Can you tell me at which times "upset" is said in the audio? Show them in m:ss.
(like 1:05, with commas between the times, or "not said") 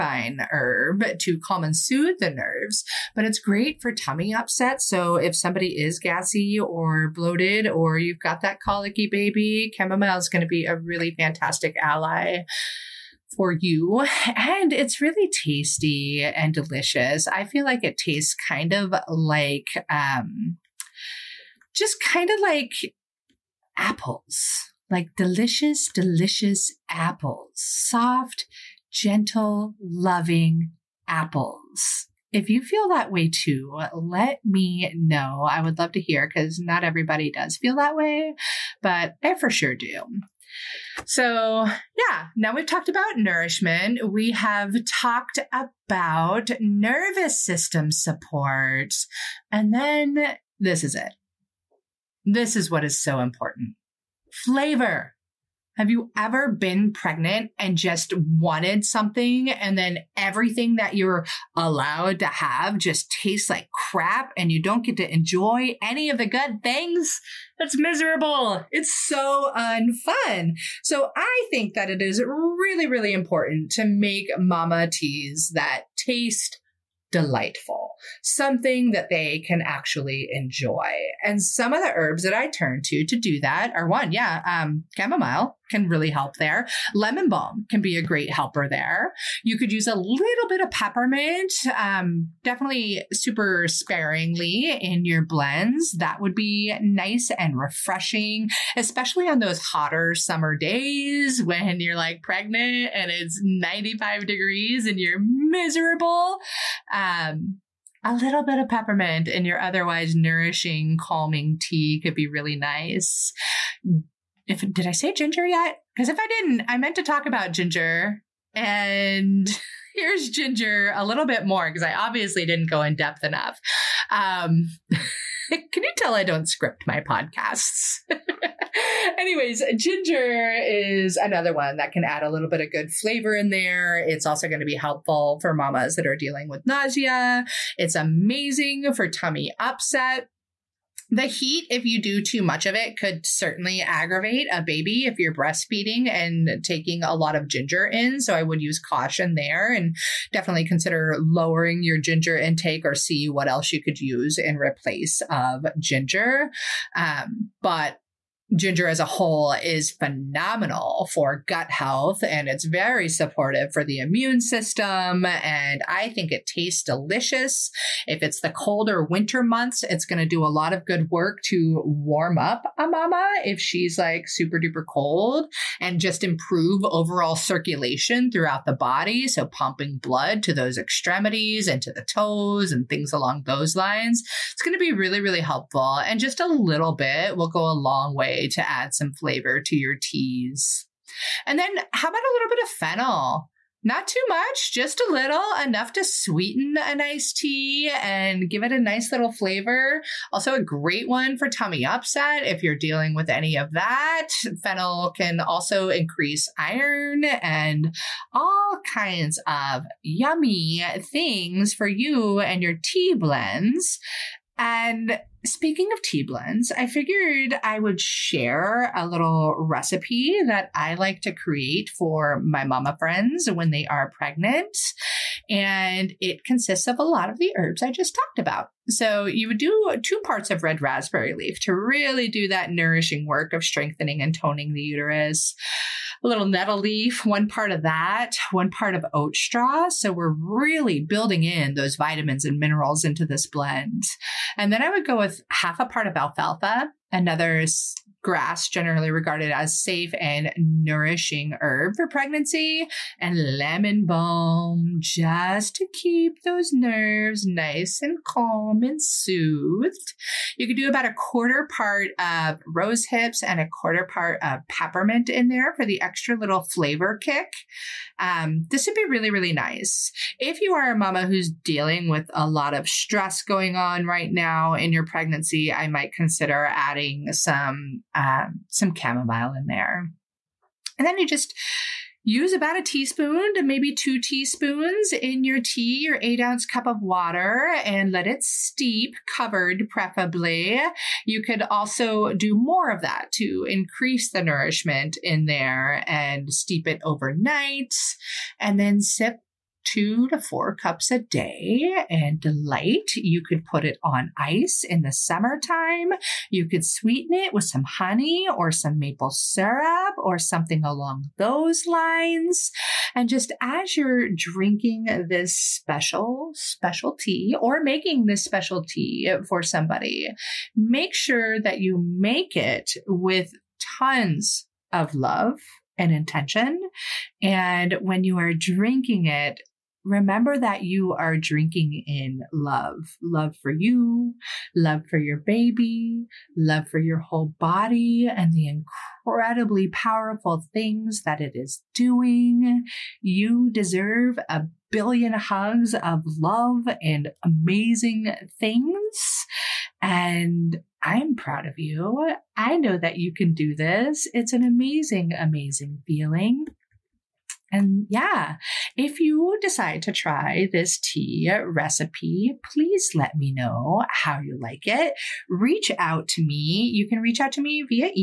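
0:04, 2:19, 3:21.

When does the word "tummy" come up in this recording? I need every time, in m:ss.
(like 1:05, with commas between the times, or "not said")
0:03, 2:19, 3:21.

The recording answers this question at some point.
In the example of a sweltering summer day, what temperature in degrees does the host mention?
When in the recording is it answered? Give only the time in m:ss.
1:43.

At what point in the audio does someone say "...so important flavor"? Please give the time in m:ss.
0:53.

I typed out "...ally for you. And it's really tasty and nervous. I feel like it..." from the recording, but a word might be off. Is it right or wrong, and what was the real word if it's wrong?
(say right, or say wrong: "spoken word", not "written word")
wrong: "delicious", not "nervous".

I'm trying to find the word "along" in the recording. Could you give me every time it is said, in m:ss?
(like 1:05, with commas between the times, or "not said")
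3:03, 5:10.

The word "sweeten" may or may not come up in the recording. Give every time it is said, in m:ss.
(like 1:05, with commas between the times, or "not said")
3:16, 5:06.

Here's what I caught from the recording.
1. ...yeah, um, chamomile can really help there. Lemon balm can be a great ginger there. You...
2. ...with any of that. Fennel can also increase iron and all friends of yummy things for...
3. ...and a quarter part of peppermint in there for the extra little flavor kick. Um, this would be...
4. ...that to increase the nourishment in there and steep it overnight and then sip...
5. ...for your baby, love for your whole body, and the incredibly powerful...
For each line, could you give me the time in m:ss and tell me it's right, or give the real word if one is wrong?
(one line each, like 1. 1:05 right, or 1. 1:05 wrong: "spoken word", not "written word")
1. 1:24 wrong: "helper", not "ginger"
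2. 3:23 wrong: "kinds", not "friends"
3. 4:23 right
4. 4:53 right
5. 5:35 right.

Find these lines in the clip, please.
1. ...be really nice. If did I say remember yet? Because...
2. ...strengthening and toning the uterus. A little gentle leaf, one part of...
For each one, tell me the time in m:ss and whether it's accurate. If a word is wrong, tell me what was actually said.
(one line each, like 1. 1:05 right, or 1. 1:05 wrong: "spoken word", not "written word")
1. 1:52 wrong: "ginger", not "remember"
2. 3:53 wrong: "nettle", not "gentle".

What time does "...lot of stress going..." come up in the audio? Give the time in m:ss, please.
4:32.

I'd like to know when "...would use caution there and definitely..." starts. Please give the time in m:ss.
2:28.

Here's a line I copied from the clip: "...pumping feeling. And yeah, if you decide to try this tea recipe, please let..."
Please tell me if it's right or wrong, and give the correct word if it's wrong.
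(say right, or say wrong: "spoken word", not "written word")
wrong: "amazing", not "pumping".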